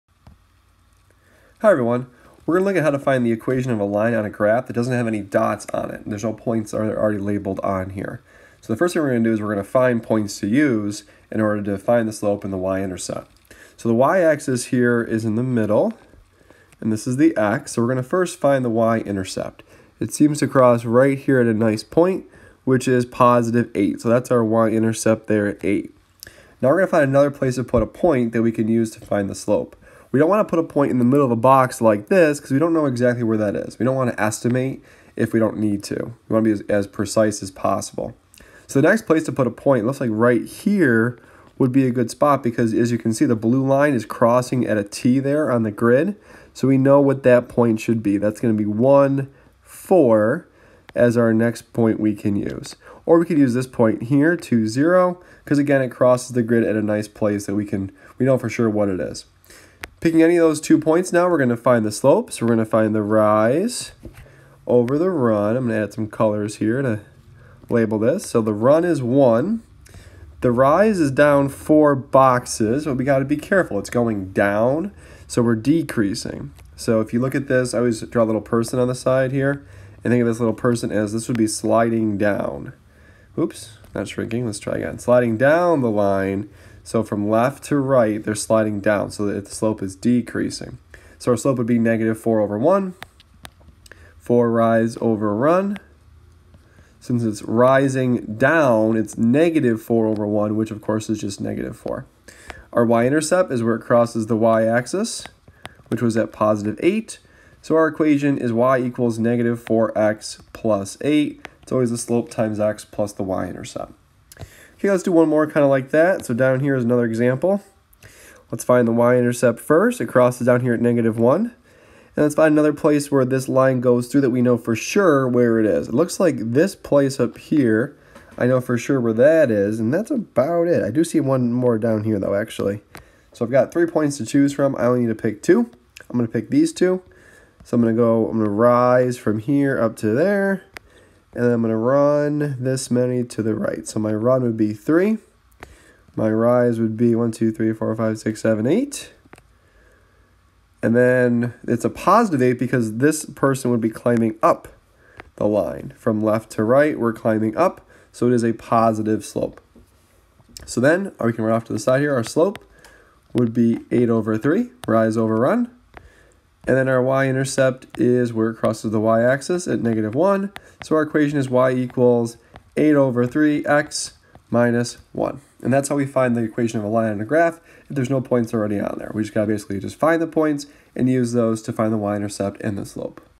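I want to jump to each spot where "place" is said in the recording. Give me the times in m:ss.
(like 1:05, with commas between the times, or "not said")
0:27, 0:39, 0:57, 2:02, 2:06.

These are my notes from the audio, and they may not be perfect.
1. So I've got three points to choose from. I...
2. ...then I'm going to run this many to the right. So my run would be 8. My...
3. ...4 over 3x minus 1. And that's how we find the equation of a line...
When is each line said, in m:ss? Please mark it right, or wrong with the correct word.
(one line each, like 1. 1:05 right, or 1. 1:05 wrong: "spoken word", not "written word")
1. 2:13 right
2. 2:21 wrong: "3", not "8"
3. 2:52 wrong: "8", not "4".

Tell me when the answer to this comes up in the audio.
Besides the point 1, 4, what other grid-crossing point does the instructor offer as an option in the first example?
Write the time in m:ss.
0:54.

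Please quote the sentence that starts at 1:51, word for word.
It's always the slope times x plus the y-intercept.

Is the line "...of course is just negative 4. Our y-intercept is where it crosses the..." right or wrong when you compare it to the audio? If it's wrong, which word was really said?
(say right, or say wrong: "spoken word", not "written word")
right.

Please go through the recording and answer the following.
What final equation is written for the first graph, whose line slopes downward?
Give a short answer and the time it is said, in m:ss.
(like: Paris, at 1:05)
y = -4x + 8, at 1:48.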